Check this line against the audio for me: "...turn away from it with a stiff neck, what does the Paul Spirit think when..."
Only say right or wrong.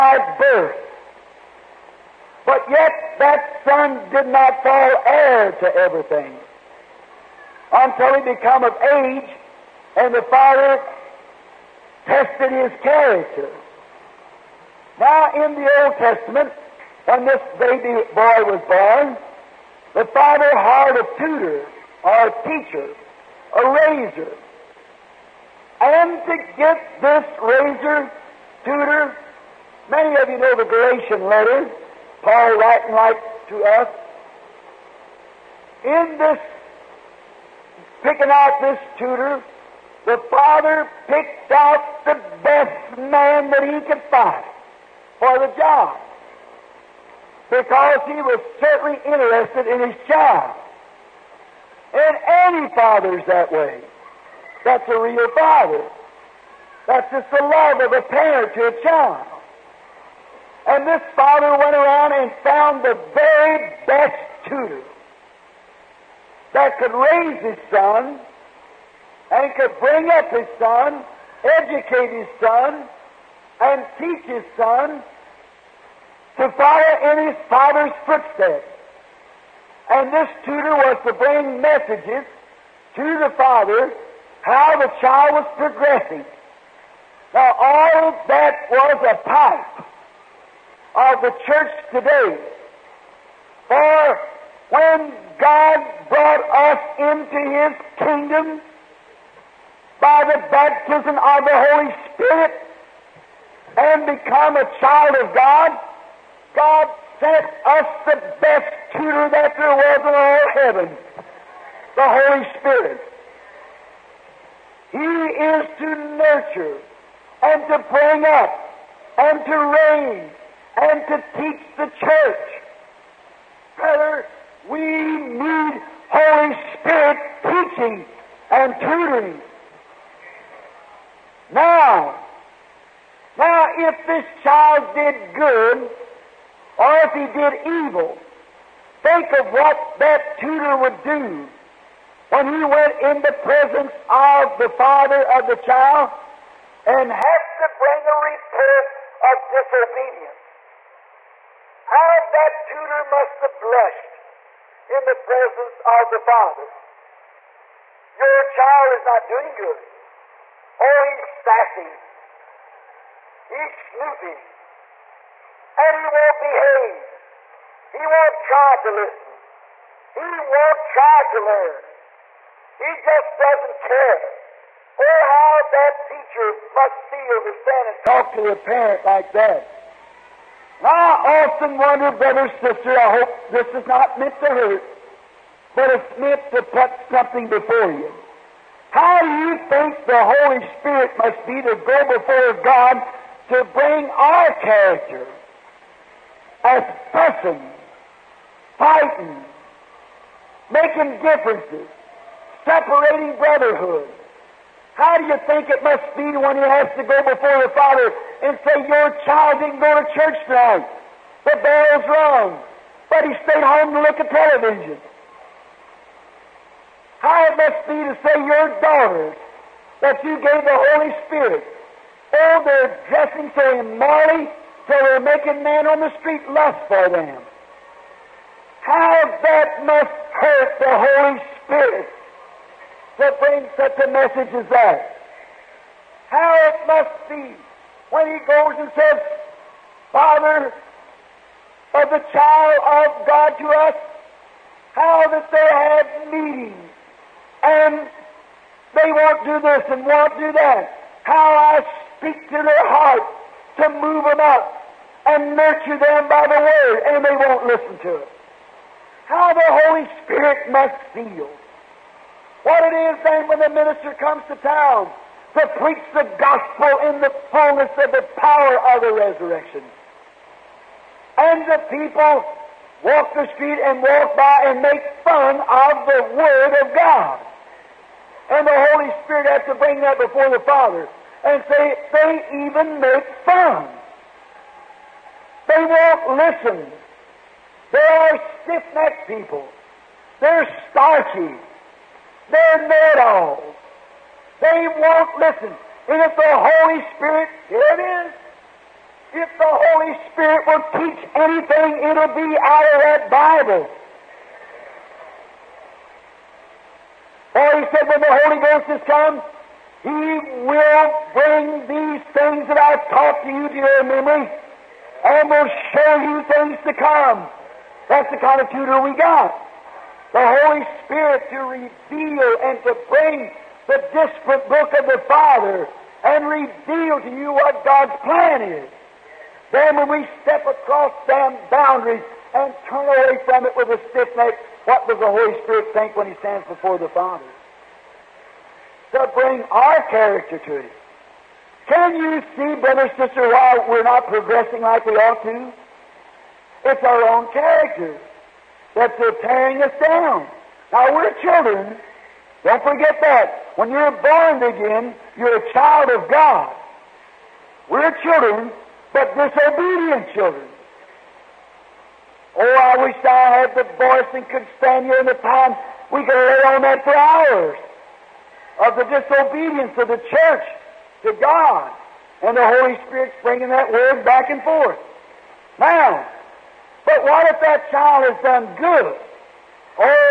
wrong.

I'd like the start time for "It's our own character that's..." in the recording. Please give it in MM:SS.
05:46.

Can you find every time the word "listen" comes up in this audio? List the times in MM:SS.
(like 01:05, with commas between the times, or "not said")
02:48, 04:17, 04:46, 04:55.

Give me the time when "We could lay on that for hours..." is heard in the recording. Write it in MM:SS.
06:06.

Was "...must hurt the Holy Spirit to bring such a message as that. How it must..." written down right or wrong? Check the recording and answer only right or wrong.
right.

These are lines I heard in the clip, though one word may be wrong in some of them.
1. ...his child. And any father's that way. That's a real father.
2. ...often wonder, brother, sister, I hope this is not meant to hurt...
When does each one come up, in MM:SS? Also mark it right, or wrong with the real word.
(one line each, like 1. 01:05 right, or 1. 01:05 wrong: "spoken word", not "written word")
1. 00:49 right
2. 03:01 right.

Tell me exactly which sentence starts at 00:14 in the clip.
Now, in the Old Testament, when this baby boy was born, the father hired a tutor or a teacher, a razor.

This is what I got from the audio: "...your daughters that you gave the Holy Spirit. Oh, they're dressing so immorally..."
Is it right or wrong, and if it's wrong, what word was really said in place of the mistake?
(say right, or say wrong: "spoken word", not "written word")
right.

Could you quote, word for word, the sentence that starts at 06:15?
Now, but what if that child has done good?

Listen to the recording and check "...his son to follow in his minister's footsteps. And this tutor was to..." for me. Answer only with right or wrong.
wrong.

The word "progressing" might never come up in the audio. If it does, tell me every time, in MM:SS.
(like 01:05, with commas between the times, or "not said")
01:25, 05:44.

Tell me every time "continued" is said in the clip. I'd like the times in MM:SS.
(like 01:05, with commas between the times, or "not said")
not said.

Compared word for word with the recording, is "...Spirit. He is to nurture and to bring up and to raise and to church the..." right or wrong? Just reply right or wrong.
wrong.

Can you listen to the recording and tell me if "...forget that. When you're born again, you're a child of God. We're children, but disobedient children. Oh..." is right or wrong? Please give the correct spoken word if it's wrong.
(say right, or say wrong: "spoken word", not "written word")
right.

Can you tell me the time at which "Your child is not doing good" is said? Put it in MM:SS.
02:38.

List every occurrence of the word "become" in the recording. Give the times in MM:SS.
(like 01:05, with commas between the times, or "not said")
00:08, 01:44.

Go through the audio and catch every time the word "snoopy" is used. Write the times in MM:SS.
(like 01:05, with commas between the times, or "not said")
02:43.